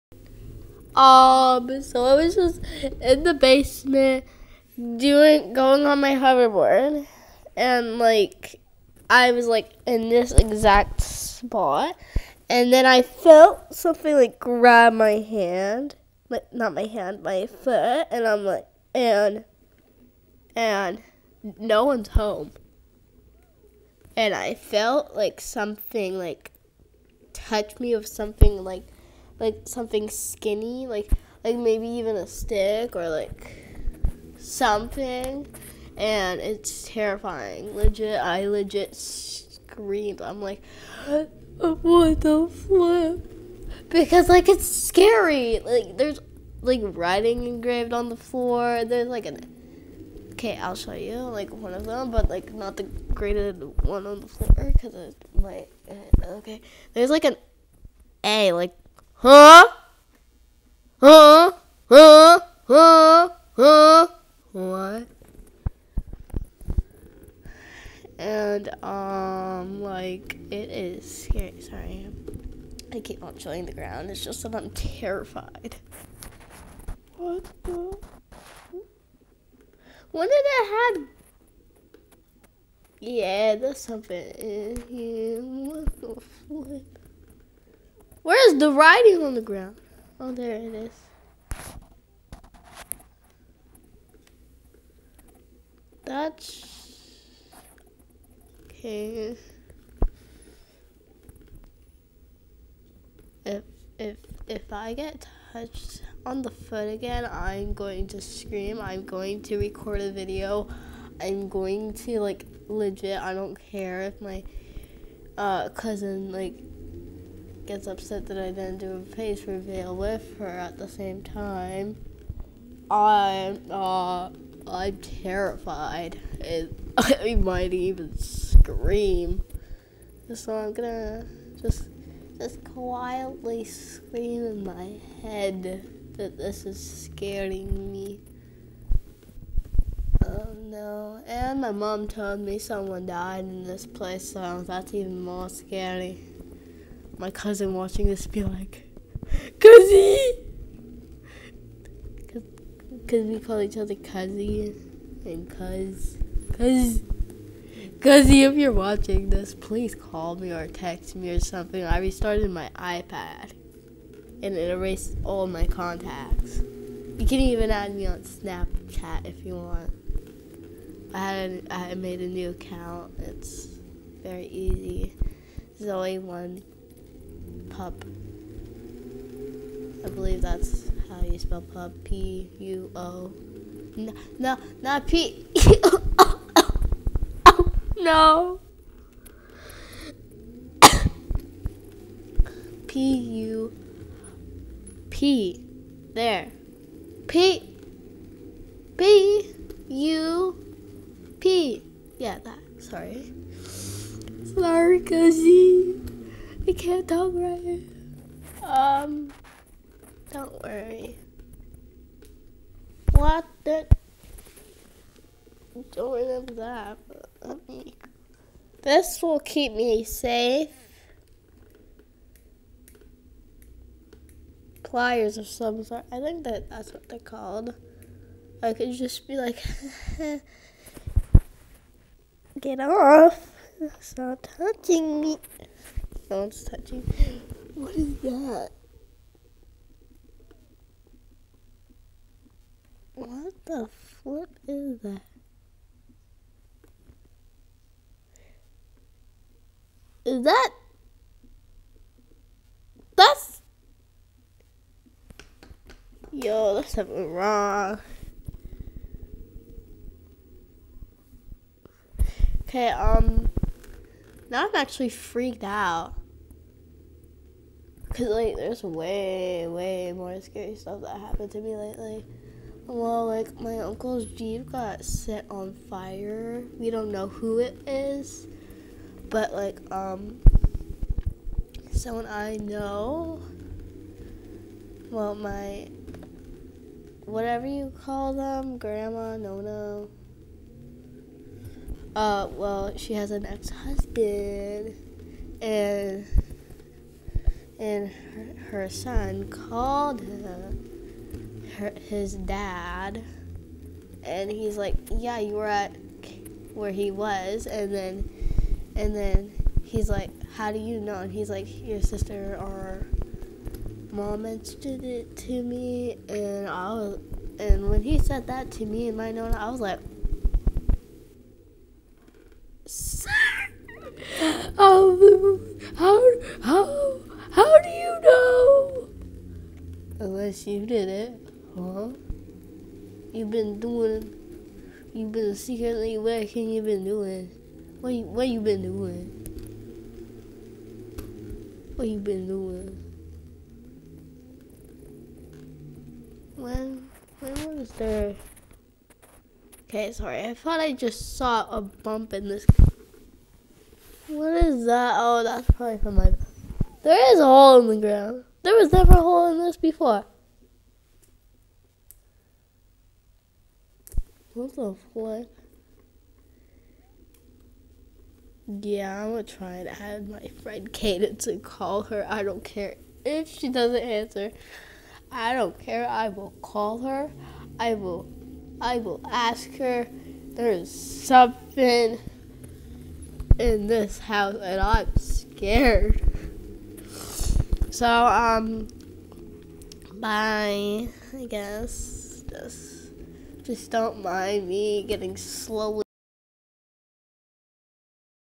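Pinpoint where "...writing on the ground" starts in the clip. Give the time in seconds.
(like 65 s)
88 s.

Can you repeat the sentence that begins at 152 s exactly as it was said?
Because we call each other Cuzzy and Cuz.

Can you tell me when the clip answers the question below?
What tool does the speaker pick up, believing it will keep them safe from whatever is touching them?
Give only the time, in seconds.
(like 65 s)
224 s.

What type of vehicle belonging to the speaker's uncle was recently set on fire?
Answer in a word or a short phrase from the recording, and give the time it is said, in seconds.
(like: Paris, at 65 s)
Jeep, at 274 s.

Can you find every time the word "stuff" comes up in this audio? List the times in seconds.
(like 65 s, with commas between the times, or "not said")
270 s.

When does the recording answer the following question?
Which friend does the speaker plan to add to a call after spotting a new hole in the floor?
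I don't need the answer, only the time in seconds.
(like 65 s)
370 s.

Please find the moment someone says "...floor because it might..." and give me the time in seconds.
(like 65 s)
54 s.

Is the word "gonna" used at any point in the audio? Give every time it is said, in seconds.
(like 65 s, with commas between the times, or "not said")
130 s, 369 s.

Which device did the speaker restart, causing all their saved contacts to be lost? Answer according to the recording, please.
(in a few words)
iPad.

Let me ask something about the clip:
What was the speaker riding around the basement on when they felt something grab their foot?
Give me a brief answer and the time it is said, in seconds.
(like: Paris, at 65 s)
Hoverboard, at 6 s.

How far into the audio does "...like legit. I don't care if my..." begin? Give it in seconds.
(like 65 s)
112 s.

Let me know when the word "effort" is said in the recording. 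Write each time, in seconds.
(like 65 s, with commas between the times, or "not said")
not said.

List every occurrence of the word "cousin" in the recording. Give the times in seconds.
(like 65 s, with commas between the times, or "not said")
115 s, 147 s.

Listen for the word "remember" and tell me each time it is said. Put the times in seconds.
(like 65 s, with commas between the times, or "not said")
216 s.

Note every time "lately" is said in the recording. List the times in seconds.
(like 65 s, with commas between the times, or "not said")
271 s.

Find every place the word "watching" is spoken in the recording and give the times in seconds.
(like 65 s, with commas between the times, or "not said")
147 s, 158 s.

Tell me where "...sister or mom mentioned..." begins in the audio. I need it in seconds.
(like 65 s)
312 s.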